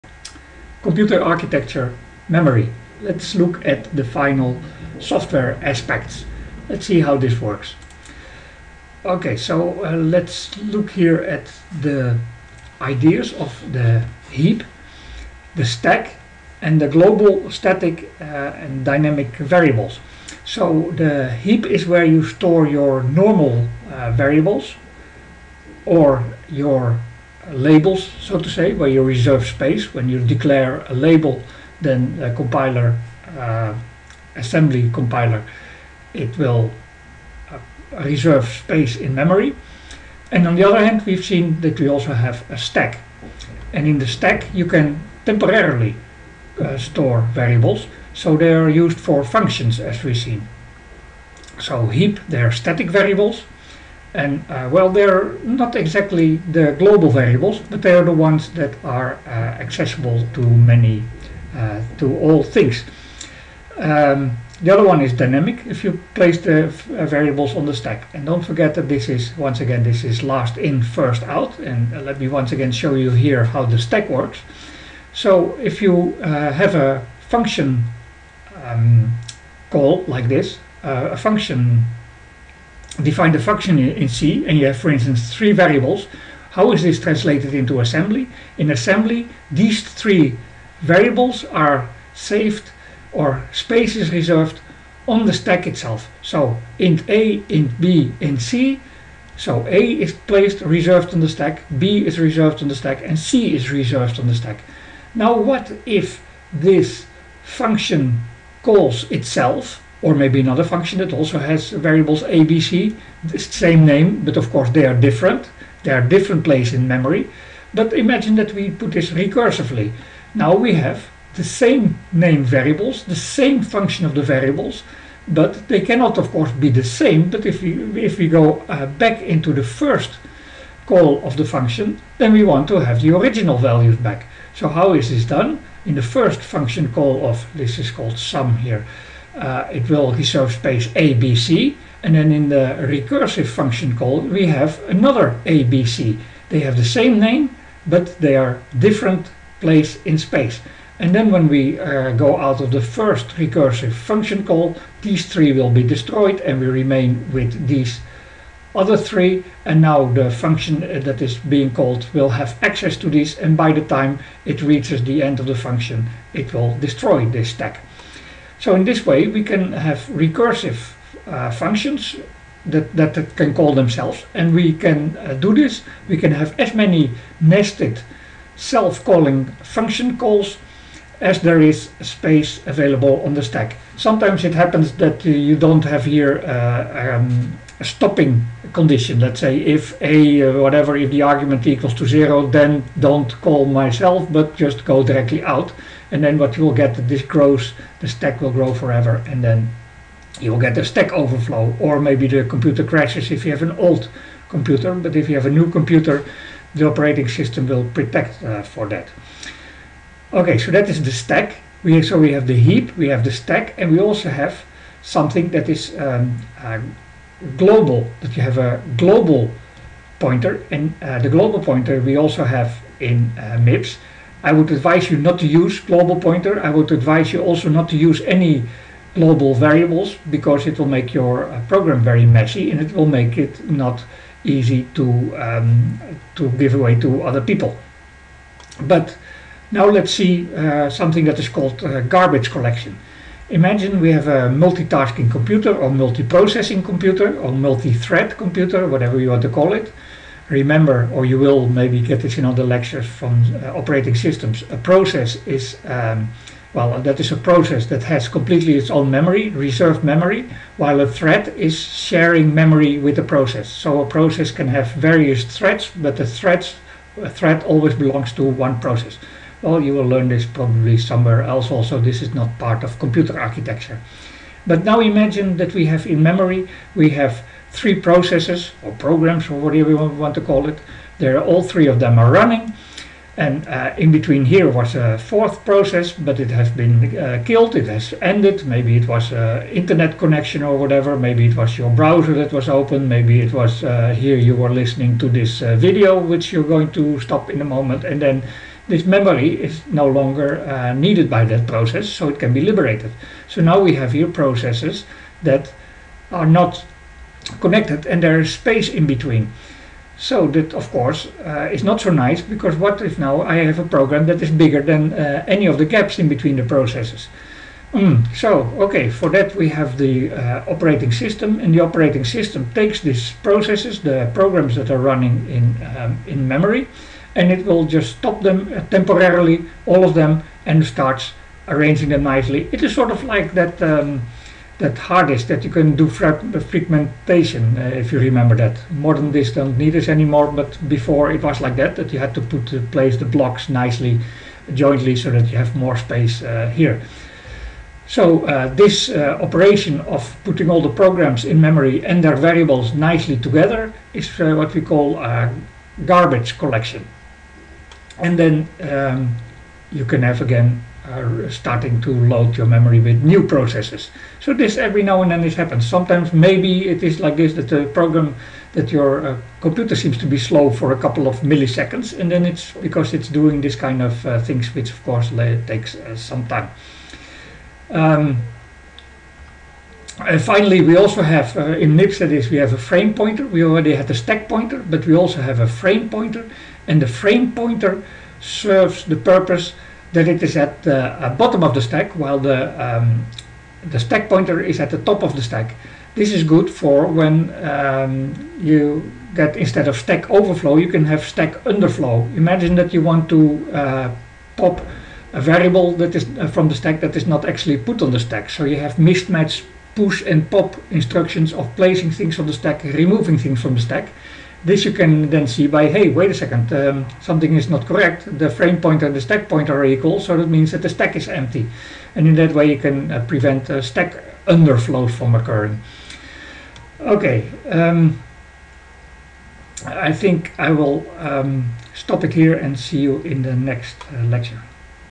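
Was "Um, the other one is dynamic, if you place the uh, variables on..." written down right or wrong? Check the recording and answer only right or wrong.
right.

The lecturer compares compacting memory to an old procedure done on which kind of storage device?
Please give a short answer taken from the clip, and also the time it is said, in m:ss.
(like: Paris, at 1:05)
hard disk, at 5:34.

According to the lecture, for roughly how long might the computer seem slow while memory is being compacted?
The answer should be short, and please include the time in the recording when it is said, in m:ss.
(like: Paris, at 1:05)
a couple of milliseconds, at 6:10.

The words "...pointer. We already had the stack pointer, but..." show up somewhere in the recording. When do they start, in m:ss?
6:23.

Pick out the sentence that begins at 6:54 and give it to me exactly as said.
This you can then see by, hey, wait a second, um, something is not correct.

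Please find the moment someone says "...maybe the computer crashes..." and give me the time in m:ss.
3:21.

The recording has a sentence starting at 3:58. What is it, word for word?
But now let's see uh, something that is called uh, garbage collection.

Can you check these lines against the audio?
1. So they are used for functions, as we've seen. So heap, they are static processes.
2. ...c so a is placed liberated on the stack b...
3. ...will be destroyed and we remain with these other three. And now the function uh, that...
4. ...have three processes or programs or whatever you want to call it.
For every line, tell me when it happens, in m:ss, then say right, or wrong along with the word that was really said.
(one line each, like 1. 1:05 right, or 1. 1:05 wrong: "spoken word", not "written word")
1. 0:48 wrong: "variables", not "processes"
2. 1:38 wrong: "reserved", not "liberated"
3. 2:35 right
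4. 4:37 right.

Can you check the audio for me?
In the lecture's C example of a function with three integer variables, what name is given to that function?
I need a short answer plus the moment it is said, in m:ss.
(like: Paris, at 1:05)
sum, at 2:17.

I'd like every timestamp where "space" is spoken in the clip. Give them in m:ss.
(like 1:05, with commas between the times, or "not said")
0:29, 0:38, 1:33, 2:20, 2:30, 3:02, 5:08, 5:45.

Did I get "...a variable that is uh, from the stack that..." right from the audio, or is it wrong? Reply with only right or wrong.
right.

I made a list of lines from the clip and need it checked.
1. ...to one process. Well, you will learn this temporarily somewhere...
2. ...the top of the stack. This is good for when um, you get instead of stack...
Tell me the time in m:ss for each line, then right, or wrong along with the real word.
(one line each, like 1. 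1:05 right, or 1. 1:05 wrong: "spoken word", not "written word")
1. 4:28 wrong: "probably", not "temporarily"
2. 6:34 right.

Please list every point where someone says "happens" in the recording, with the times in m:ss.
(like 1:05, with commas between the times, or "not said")
3:04, 6:05.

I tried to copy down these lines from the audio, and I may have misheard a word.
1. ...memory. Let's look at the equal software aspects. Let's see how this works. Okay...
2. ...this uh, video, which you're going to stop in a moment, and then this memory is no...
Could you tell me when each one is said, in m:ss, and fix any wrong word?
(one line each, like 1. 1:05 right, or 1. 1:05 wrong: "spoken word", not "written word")
1. 0:02 wrong: "final", not "equal"
2. 4:55 right.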